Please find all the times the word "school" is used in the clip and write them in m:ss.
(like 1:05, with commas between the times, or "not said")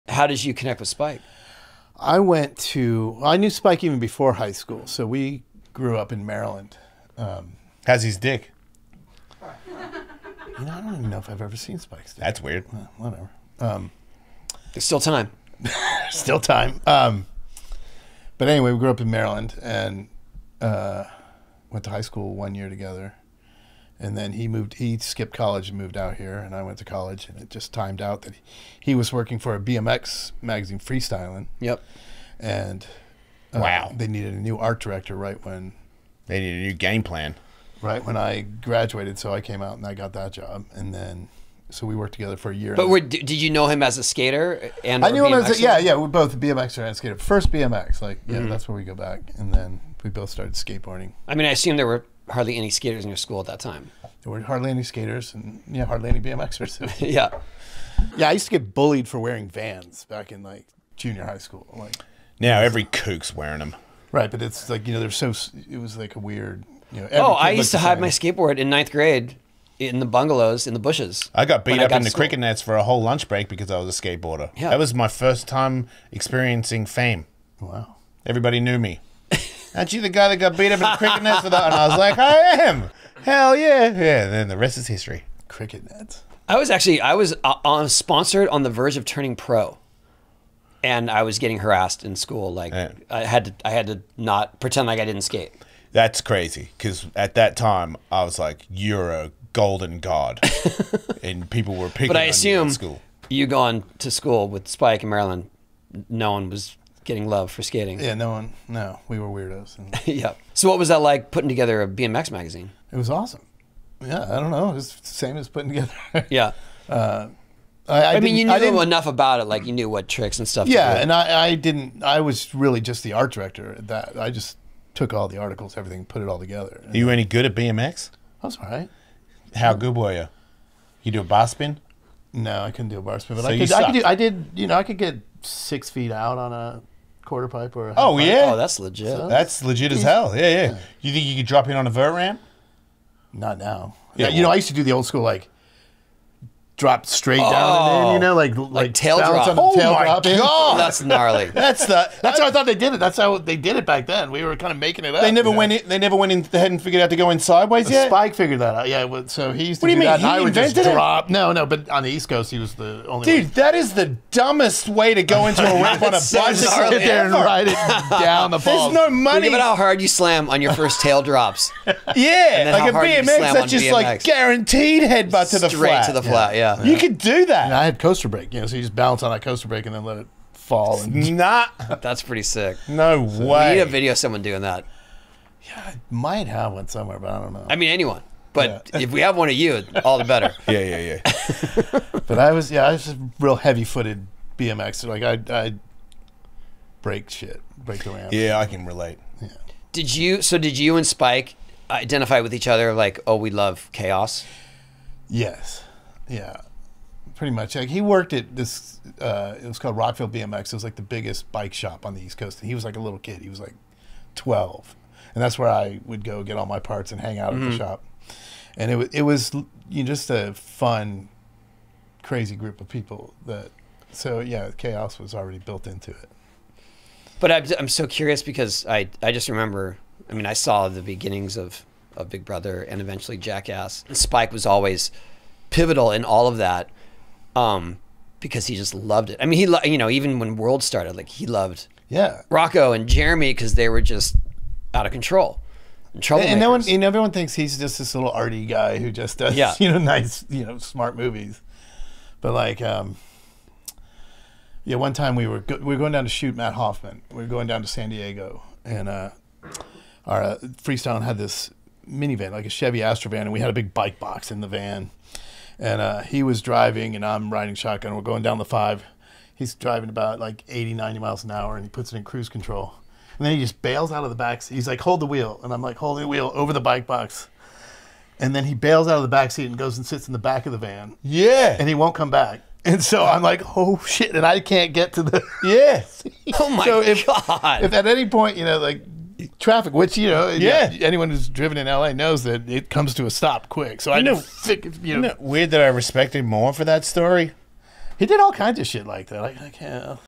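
0:04, 0:22, 0:53, 1:01, 1:32, 1:44, 2:25.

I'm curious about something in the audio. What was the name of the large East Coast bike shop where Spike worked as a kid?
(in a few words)
Rockville BMX.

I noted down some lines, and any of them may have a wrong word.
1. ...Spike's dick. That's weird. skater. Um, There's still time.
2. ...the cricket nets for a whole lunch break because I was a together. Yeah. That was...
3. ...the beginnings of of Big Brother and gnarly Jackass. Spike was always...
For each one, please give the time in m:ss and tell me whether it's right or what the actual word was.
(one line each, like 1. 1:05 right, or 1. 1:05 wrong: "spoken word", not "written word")
1. 0:11 wrong: "whatever", not "skater"
2. 1:12 wrong: "skateboarder", not "together"
3. 3:50 wrong: "eventually", not "gnarly".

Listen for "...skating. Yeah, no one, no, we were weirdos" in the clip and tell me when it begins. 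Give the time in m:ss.
1:47.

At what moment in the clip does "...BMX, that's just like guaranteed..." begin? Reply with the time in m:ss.
2:52.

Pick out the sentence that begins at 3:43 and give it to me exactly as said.
That so yeah, chaos was already built into it.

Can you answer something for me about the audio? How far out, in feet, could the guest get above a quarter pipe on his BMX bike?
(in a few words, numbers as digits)
6 feet.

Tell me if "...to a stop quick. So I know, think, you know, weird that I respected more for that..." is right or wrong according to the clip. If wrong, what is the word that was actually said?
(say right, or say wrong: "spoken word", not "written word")
right.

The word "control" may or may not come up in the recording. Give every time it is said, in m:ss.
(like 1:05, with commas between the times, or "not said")
4:05, 4:32.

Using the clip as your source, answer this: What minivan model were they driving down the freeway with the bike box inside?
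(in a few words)
Chevy Astro van.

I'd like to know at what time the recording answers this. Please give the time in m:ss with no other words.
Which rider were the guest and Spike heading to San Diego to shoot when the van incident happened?
4:16.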